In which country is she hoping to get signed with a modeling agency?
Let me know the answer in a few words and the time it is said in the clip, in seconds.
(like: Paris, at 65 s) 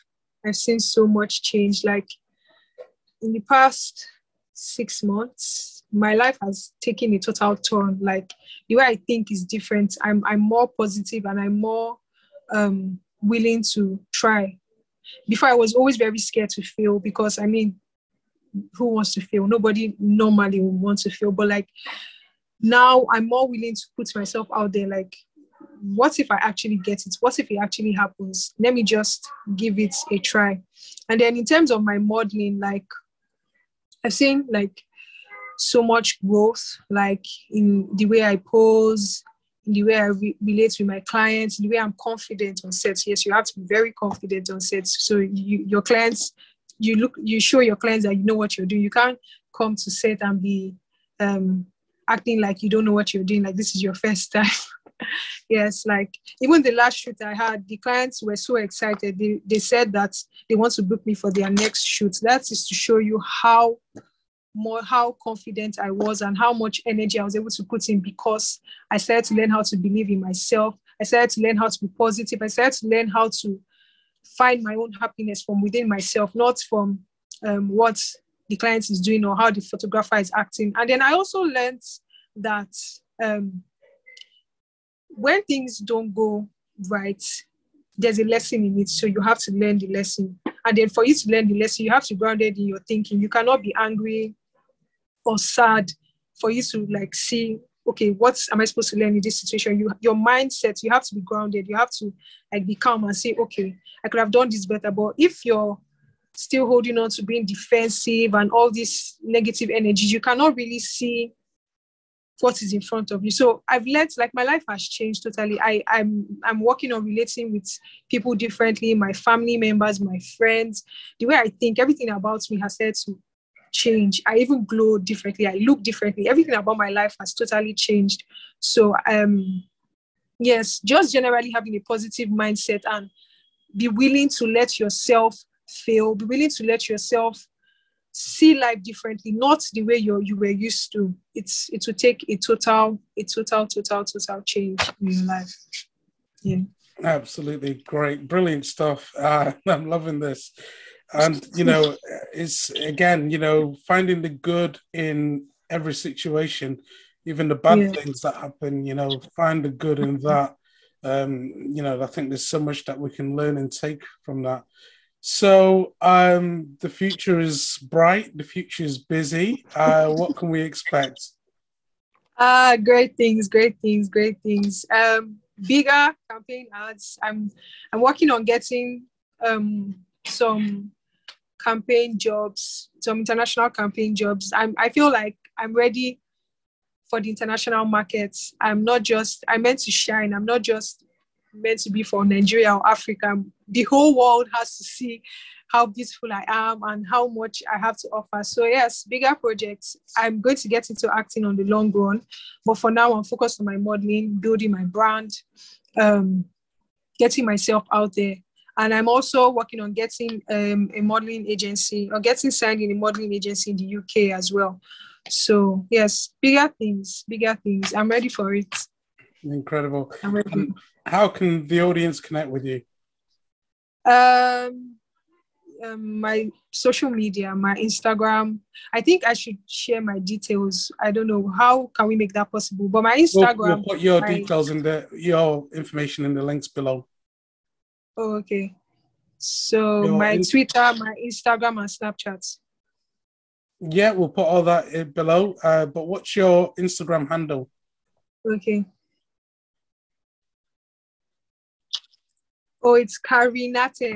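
UK, at 213 s.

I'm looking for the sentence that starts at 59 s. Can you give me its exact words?
They, they said that they want to book me for their next shoot.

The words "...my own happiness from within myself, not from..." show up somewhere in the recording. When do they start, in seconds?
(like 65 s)
74 s.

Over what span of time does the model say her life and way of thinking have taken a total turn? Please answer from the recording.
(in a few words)
six months.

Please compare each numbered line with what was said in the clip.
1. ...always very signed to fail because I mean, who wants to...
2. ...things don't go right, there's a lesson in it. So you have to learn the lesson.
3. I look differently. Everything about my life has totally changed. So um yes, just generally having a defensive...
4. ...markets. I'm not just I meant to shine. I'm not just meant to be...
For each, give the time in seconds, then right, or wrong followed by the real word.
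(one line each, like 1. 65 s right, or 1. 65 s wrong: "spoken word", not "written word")
1. 15 s wrong: "scared", not "signed"
2. 85 s right
3. 125 s wrong: "positive", not "defensive"
4. 187 s right.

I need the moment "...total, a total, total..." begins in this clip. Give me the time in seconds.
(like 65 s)
142 s.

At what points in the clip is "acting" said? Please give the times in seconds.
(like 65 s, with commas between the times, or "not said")
52 s, 80 s, 201 s.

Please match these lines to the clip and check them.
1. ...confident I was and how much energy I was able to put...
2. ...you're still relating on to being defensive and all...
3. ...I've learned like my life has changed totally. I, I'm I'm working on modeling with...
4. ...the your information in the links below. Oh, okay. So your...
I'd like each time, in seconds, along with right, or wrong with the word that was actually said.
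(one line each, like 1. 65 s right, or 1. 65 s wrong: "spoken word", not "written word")
1. 65 s right
2. 105 s wrong: "holding", not "relating"
3. 113 s wrong: "relating", not "modeling"
4. 234 s right.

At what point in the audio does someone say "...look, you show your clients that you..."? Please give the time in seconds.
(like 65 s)
46 s.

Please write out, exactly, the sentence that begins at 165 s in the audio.
So um, the future is bright.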